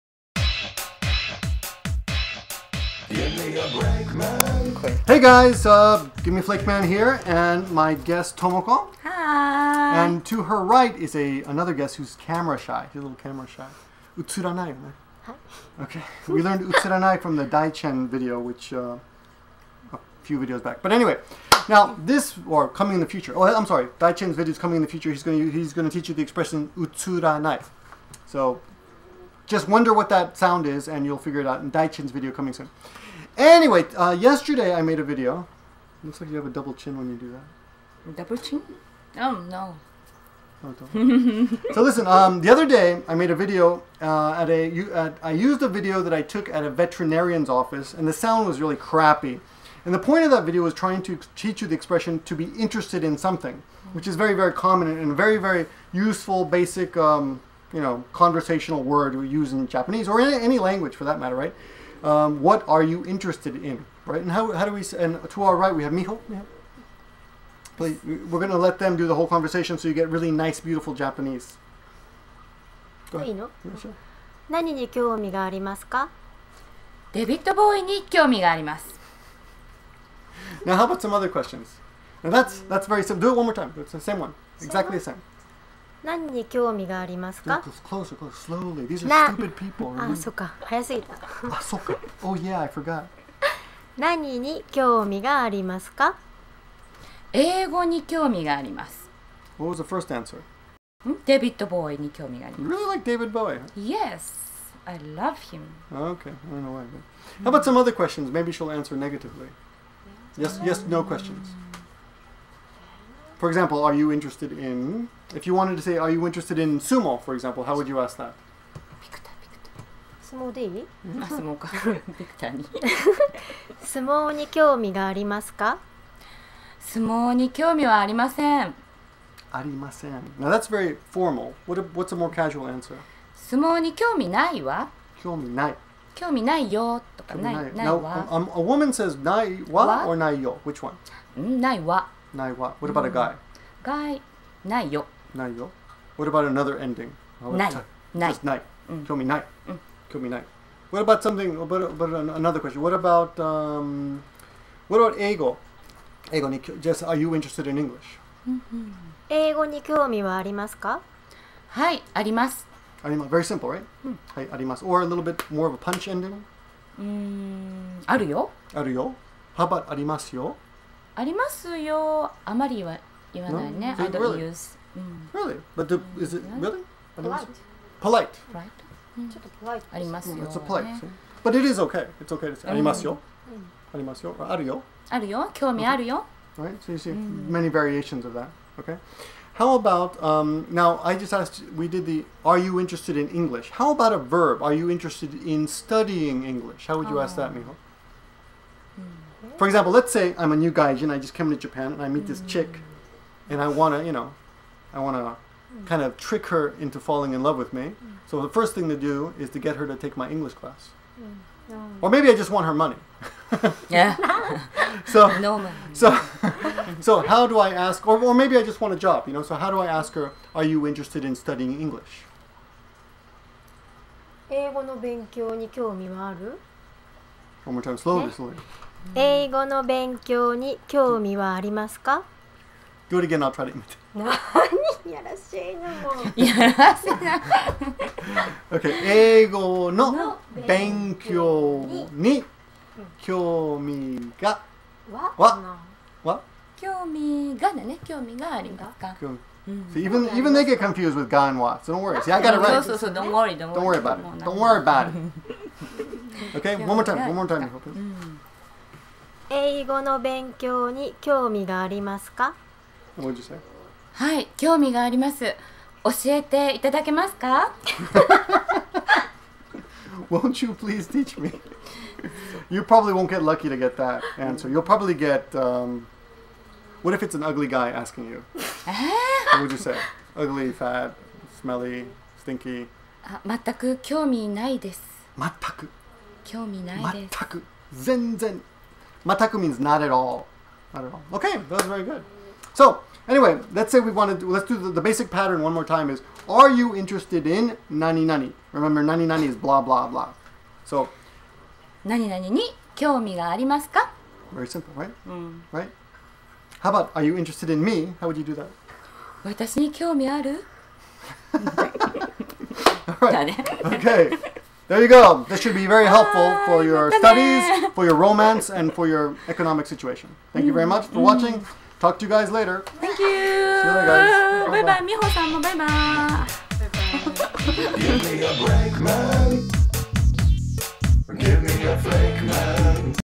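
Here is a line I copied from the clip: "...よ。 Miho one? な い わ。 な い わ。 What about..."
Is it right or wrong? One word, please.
wrong.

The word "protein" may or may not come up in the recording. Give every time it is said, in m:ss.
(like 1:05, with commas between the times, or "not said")
not said.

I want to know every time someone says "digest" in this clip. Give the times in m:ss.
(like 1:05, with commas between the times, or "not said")
not said.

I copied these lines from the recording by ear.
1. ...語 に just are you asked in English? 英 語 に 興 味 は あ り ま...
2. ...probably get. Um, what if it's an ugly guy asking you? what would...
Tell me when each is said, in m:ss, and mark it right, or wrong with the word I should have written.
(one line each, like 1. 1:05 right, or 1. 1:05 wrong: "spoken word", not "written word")
1. 2:36 wrong: "interested", not "asked"
2. 4:34 right.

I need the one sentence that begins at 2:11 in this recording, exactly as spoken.
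What a, what's a more casual answer?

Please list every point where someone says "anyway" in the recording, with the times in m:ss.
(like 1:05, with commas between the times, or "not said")
0:20, 0:33, 4:53.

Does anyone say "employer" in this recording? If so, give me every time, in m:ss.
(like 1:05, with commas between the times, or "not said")
not said.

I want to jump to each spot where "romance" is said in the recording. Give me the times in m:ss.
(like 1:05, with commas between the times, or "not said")
5:18.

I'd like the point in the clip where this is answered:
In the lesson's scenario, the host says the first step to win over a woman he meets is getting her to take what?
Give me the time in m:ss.
3:30.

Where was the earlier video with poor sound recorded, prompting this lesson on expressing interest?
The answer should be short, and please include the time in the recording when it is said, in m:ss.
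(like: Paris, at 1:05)
veterinarian's office, at 0:46.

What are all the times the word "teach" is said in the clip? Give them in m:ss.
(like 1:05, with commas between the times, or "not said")
0:25, 0:51, 4:31.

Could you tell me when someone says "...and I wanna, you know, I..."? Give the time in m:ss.
3:23.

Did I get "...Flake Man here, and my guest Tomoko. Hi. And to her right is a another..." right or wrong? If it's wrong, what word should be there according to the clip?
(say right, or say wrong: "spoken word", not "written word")
right.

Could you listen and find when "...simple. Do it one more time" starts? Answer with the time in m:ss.
1:23.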